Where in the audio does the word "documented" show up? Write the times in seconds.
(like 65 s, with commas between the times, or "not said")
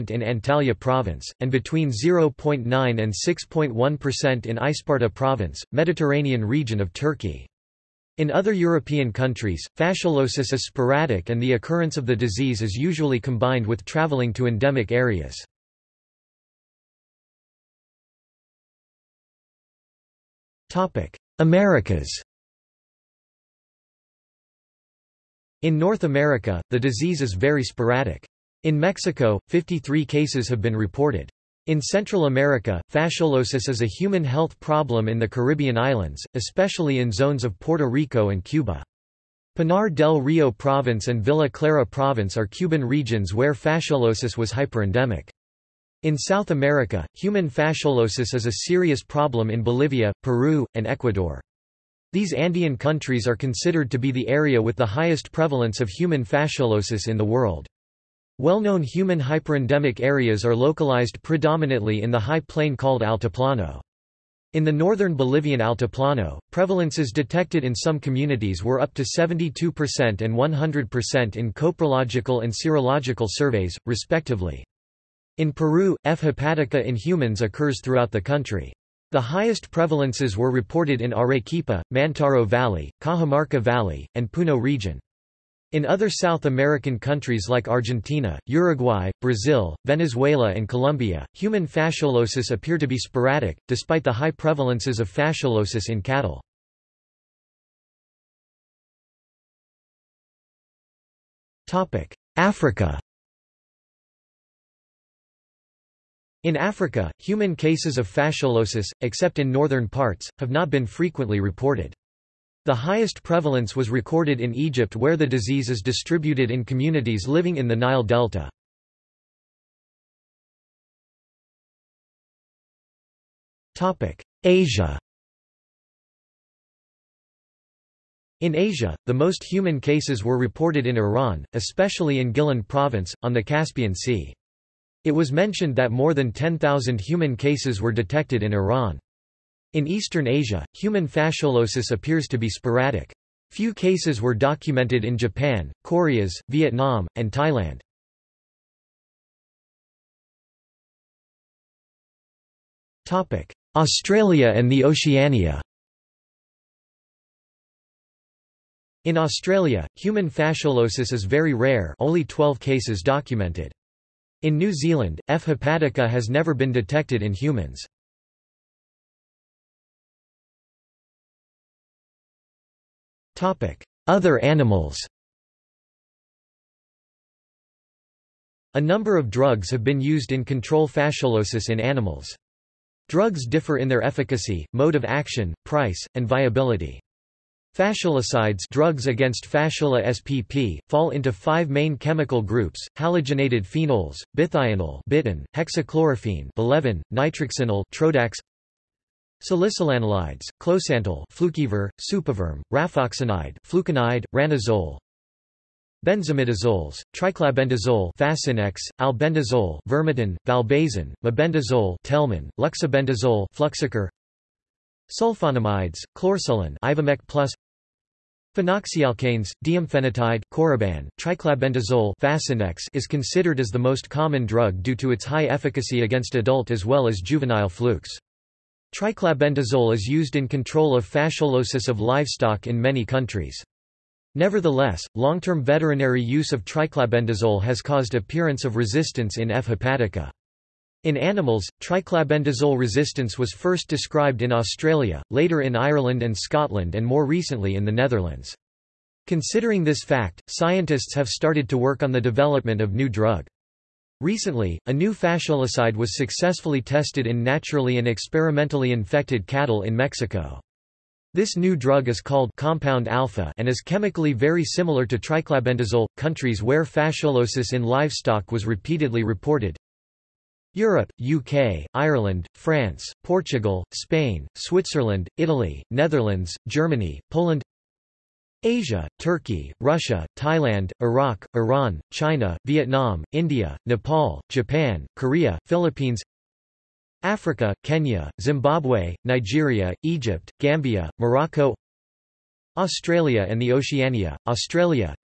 144 s, 163 s.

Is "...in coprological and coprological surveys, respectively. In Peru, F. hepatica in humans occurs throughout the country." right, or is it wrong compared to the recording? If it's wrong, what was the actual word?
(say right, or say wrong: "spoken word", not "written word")
wrong: "serological", not "coprological".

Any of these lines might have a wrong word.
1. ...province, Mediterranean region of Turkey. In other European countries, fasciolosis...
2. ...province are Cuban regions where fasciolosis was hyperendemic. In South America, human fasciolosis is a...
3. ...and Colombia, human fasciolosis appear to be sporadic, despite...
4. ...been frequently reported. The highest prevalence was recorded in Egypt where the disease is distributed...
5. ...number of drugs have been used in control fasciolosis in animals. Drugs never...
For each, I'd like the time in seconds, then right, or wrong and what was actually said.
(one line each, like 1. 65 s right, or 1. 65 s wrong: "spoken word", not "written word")
1. 5 s right
2. 41 s right
3. 90 s right
4. 110 s right
5. 178 s wrong: "differ", not "never".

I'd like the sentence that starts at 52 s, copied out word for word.
These Andean countries are considered to be the area with the highest prevalence of human fasciolosis in the world.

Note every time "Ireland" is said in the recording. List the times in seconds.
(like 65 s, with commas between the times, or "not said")
245 s, 271 s.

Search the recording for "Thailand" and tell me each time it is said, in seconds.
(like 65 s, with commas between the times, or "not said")
147 s, 280 s.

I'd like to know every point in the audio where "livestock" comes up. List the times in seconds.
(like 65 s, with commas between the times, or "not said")
231 s, 267 s.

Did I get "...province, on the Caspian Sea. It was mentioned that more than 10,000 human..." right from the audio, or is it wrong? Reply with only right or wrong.
right.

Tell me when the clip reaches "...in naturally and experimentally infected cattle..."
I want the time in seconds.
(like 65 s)
257 s.